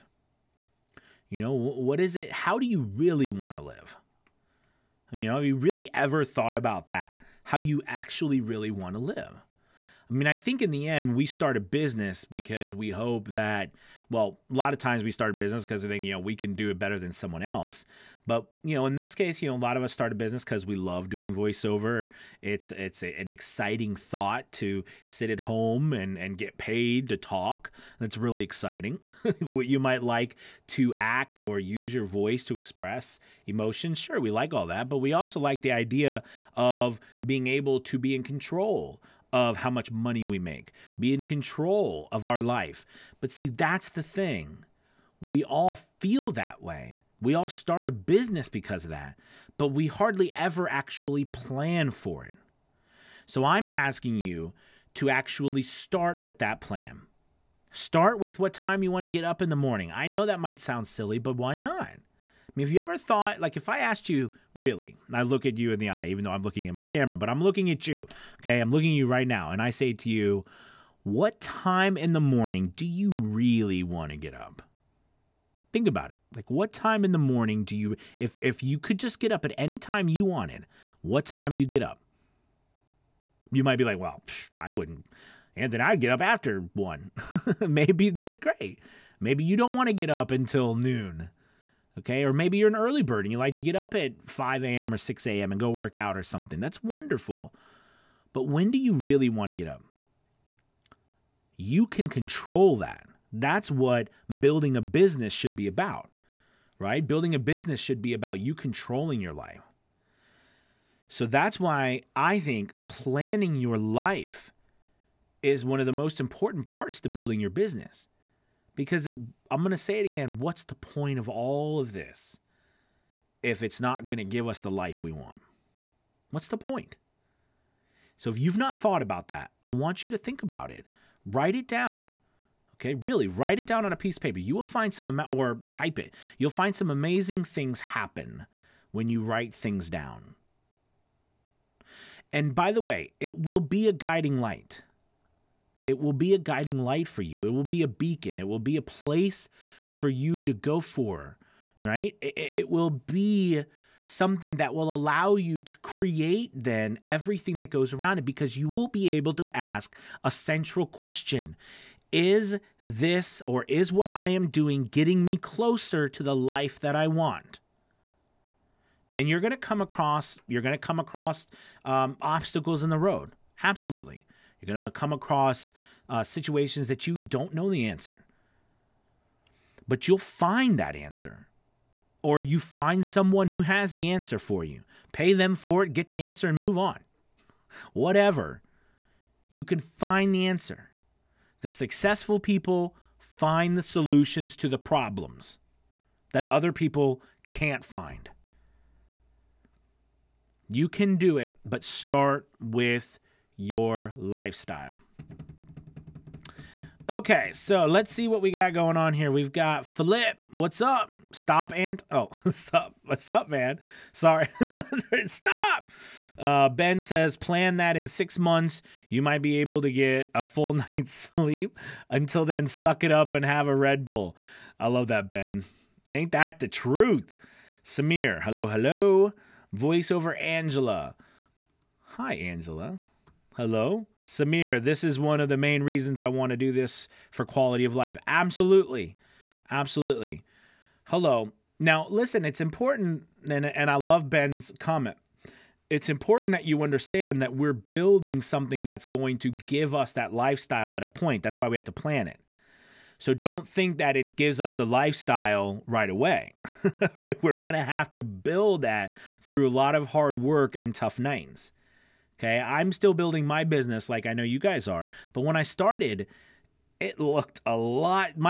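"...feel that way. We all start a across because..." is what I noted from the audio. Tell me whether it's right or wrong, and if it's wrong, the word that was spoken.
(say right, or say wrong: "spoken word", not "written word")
wrong: "business", not "across".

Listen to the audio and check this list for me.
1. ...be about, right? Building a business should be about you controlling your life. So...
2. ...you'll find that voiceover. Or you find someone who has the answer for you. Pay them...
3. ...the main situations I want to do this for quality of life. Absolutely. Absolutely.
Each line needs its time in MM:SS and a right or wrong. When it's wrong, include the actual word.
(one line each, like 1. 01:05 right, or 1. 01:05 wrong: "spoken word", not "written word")
1. 01:45 right
2. 03:00 wrong: "answer", not "voiceover"
3. 03:55 wrong: "reasons", not "situations".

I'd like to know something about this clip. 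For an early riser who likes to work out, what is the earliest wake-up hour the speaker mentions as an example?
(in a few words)
5 a.m.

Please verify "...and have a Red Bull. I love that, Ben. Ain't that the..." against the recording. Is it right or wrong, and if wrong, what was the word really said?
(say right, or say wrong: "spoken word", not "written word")
right.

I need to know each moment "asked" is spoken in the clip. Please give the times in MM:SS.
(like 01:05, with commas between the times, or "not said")
01:03.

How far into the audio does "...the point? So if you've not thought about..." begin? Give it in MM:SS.
02:06.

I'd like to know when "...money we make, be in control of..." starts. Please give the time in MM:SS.
00:39.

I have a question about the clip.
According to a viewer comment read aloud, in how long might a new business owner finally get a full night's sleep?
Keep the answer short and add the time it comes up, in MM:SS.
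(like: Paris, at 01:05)
six months, at 03:38.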